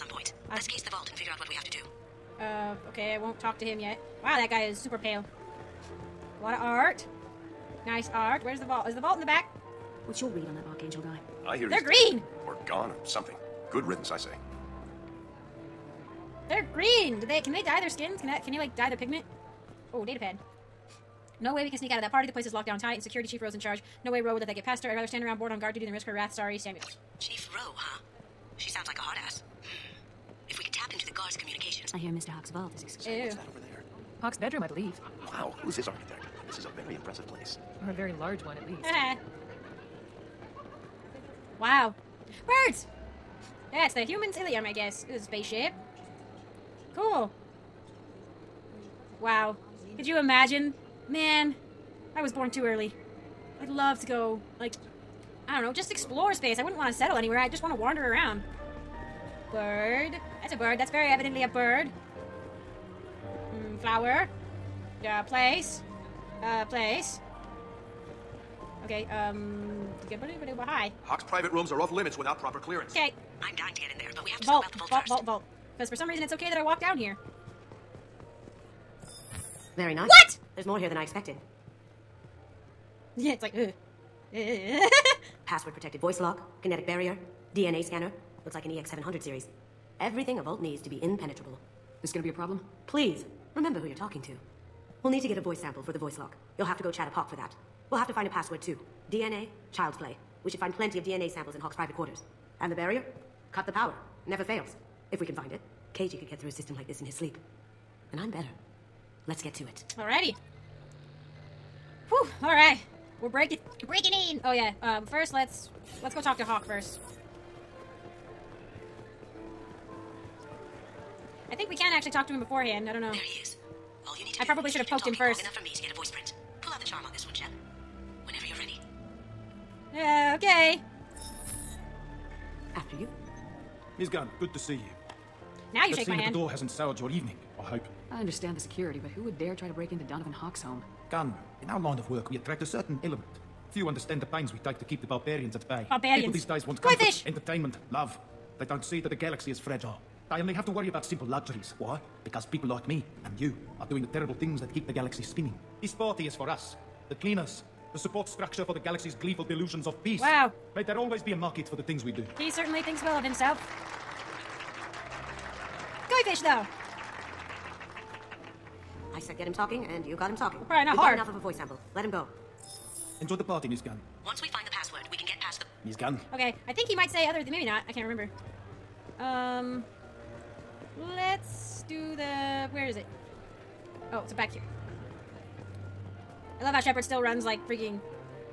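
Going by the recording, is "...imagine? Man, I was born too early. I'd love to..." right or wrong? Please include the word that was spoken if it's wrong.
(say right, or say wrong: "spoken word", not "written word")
right.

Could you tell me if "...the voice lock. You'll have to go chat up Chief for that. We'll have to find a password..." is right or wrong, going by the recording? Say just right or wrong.
wrong.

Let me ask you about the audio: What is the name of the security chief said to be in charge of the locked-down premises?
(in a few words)
Rose.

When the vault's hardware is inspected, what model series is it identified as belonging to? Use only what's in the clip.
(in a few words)
EX700.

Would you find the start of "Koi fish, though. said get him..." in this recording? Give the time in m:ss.
2:46.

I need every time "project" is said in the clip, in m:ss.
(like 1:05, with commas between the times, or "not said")
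not said.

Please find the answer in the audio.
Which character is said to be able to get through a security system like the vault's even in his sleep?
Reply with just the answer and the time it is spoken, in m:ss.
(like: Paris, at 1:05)
Keiji, at 1:45.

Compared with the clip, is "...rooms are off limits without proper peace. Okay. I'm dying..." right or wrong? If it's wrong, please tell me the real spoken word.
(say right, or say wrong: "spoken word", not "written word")
wrong: "clearance", not "peace".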